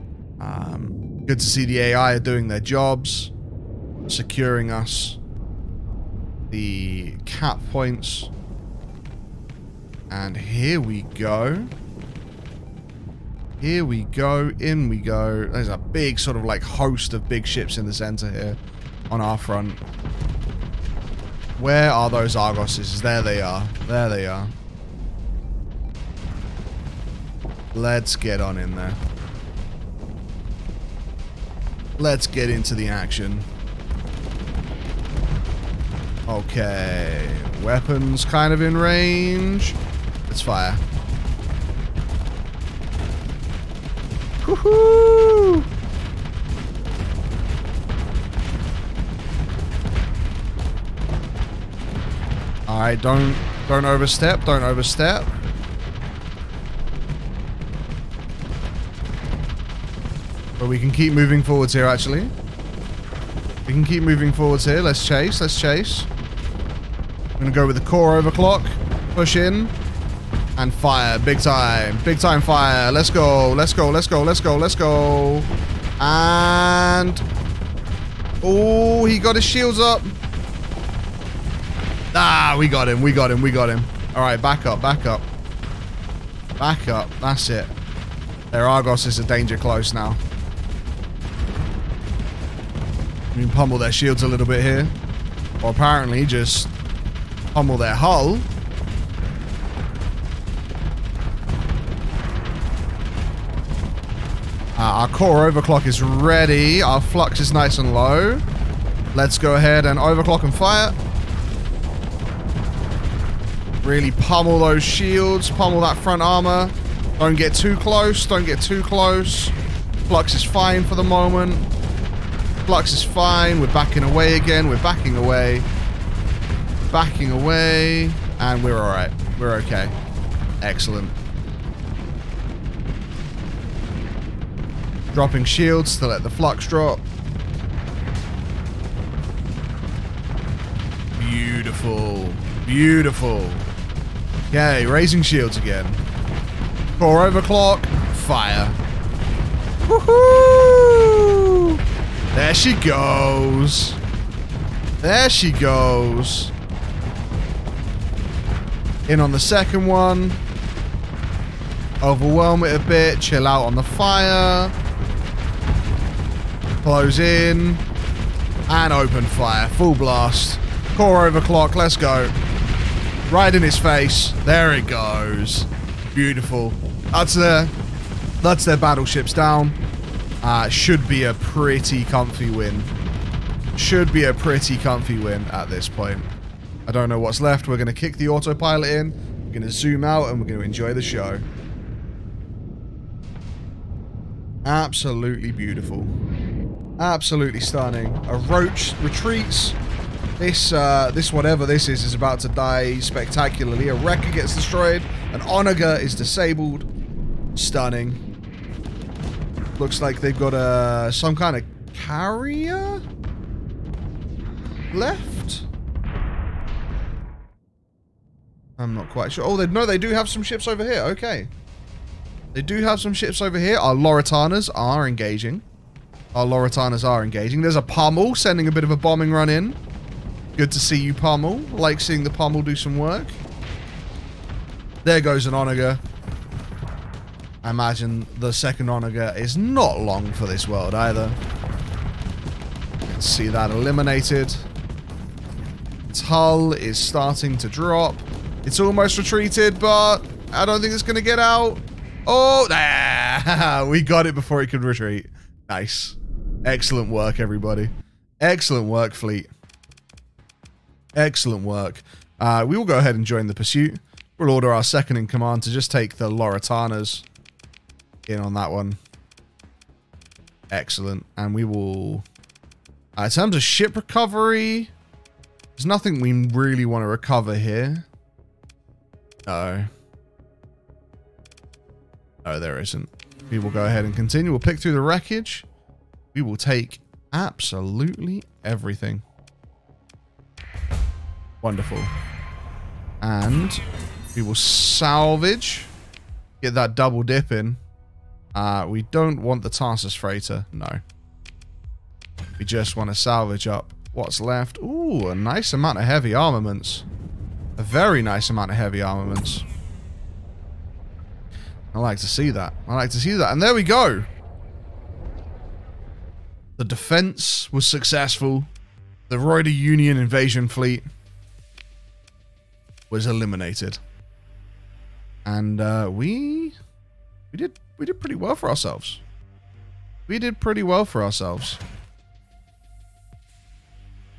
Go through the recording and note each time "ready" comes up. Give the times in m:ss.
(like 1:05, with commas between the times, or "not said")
1:46.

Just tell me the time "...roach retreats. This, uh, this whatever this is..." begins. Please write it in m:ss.
3:18.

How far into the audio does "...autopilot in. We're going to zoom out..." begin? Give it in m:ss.
3:08.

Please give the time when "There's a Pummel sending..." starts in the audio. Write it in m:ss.
3:47.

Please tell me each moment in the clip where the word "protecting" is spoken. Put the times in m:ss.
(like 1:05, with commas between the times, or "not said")
not said.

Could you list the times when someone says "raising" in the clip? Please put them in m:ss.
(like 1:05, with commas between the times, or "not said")
2:24.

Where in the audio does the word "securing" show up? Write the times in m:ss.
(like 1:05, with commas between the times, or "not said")
0:04.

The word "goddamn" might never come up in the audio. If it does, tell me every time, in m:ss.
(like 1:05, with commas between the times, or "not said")
not said.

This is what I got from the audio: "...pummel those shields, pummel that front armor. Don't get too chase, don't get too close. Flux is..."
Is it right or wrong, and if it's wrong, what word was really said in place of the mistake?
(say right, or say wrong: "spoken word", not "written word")
wrong: "close", not "chase".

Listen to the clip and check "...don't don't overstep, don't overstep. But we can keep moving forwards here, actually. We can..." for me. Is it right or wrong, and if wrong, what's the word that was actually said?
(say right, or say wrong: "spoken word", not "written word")
right.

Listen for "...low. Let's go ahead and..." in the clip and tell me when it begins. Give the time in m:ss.
1:47.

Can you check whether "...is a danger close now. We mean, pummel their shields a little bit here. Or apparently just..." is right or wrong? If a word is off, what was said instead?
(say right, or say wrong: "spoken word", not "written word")
right.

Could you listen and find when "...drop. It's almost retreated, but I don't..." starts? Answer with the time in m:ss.
4:07.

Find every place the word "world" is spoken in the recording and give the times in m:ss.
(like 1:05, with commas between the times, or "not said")
4:00.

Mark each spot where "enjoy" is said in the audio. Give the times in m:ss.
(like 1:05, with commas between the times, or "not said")
3:10.